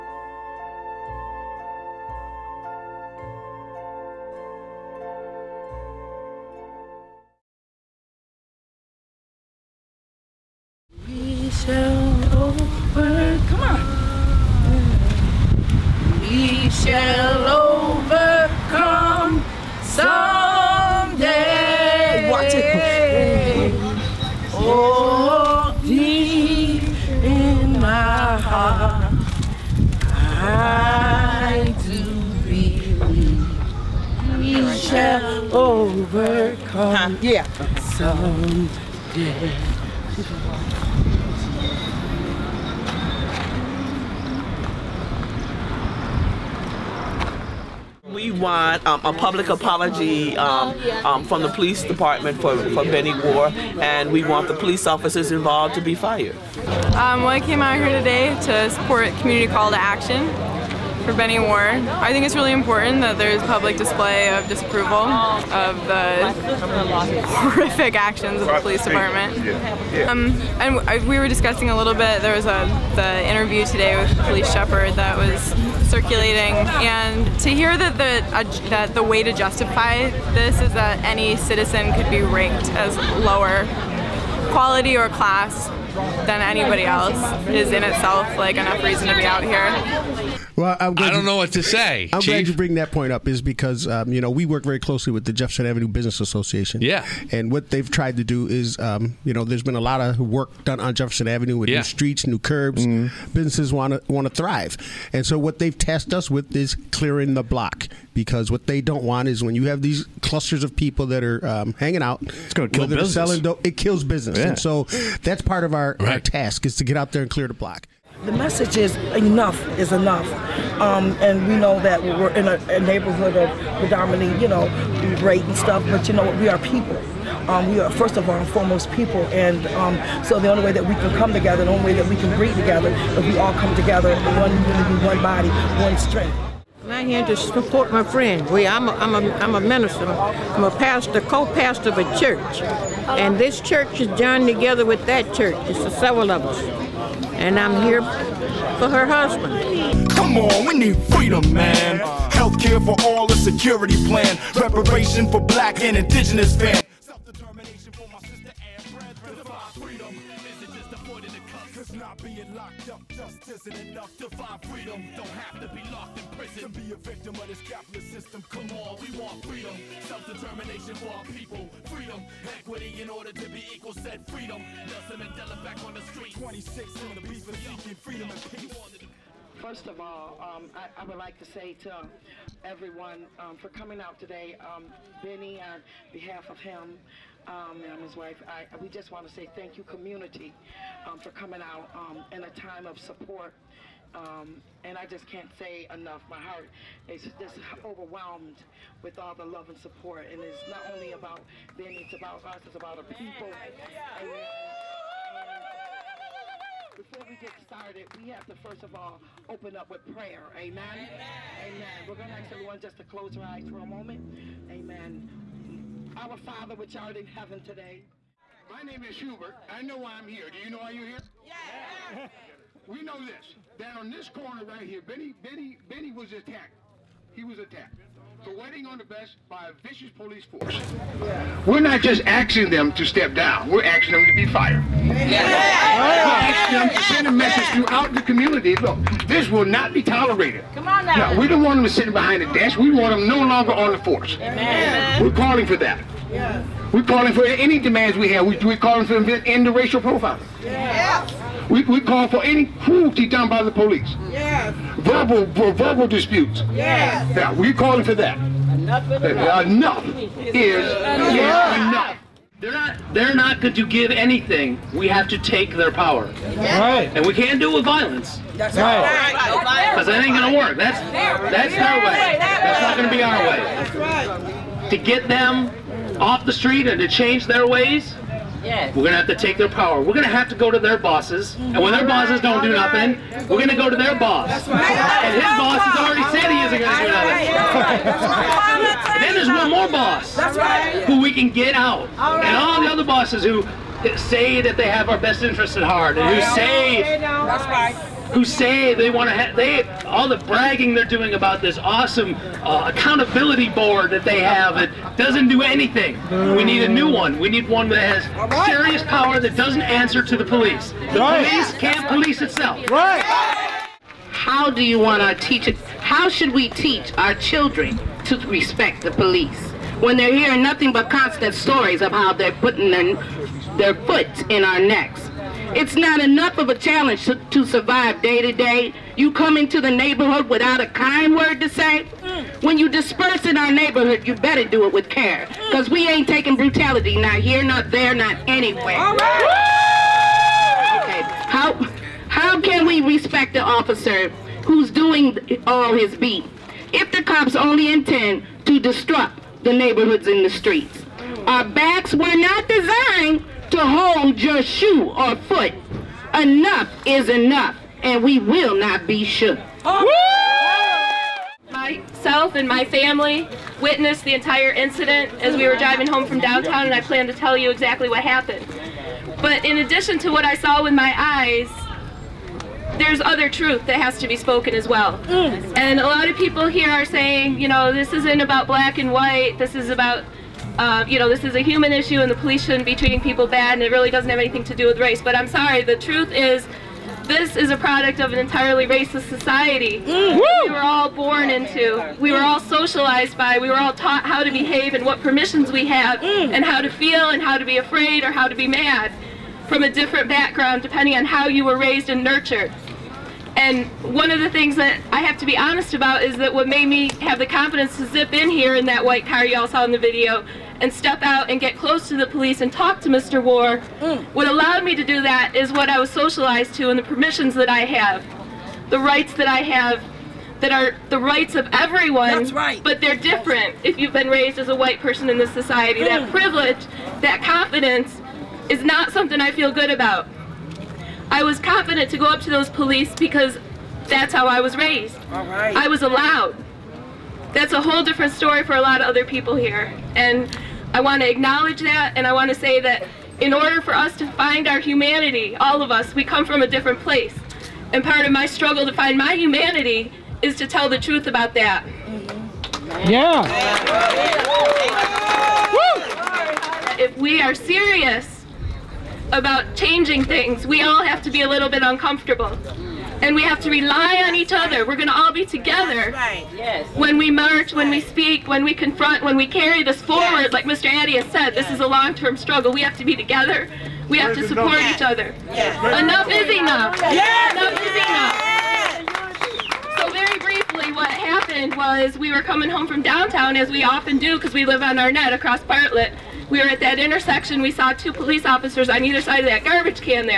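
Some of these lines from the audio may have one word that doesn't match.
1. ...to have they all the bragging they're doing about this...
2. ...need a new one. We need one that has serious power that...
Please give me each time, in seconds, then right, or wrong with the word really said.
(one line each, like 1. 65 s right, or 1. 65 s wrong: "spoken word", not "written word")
1. 299 s right
2. 306 s right.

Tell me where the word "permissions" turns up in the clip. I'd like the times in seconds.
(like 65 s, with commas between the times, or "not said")
395 s, 417 s.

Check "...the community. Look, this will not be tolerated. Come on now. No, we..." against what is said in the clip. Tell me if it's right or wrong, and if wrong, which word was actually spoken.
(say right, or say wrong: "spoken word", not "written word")
right.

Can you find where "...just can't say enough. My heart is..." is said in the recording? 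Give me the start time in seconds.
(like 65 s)
195 s.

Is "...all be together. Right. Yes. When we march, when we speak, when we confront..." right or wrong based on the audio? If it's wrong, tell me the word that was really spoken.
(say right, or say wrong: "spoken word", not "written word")
right.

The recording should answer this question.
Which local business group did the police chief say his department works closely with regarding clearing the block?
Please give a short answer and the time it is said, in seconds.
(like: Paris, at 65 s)
Jefferson Avenue Business Association, at 95 s.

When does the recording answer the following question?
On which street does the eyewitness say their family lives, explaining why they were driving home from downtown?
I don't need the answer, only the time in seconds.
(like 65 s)
484 s.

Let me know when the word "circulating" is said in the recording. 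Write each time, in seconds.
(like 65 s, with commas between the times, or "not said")
75 s.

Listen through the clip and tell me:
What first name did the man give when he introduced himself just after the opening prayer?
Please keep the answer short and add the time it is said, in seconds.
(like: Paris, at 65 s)
Hubert, at 219 s.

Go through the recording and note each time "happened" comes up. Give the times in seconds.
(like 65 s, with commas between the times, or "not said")
368 s, 481 s.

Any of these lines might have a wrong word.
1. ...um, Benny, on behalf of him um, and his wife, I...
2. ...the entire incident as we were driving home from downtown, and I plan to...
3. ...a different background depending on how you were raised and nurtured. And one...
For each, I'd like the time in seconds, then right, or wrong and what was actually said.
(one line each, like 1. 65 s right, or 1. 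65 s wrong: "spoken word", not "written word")
1. 184 s right
2. 364 s right
3. 399 s right.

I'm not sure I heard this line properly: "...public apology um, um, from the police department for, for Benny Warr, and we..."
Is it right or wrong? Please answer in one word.
right.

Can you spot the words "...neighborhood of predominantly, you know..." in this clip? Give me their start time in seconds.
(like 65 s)
122 s.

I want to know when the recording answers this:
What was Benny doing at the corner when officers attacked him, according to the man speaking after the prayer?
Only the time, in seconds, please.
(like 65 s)
228 s.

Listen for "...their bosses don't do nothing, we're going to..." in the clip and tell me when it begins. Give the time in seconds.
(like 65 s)
281 s.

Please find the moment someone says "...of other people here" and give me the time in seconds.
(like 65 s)
439 s.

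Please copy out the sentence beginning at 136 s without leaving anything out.
I'm here to support my friend.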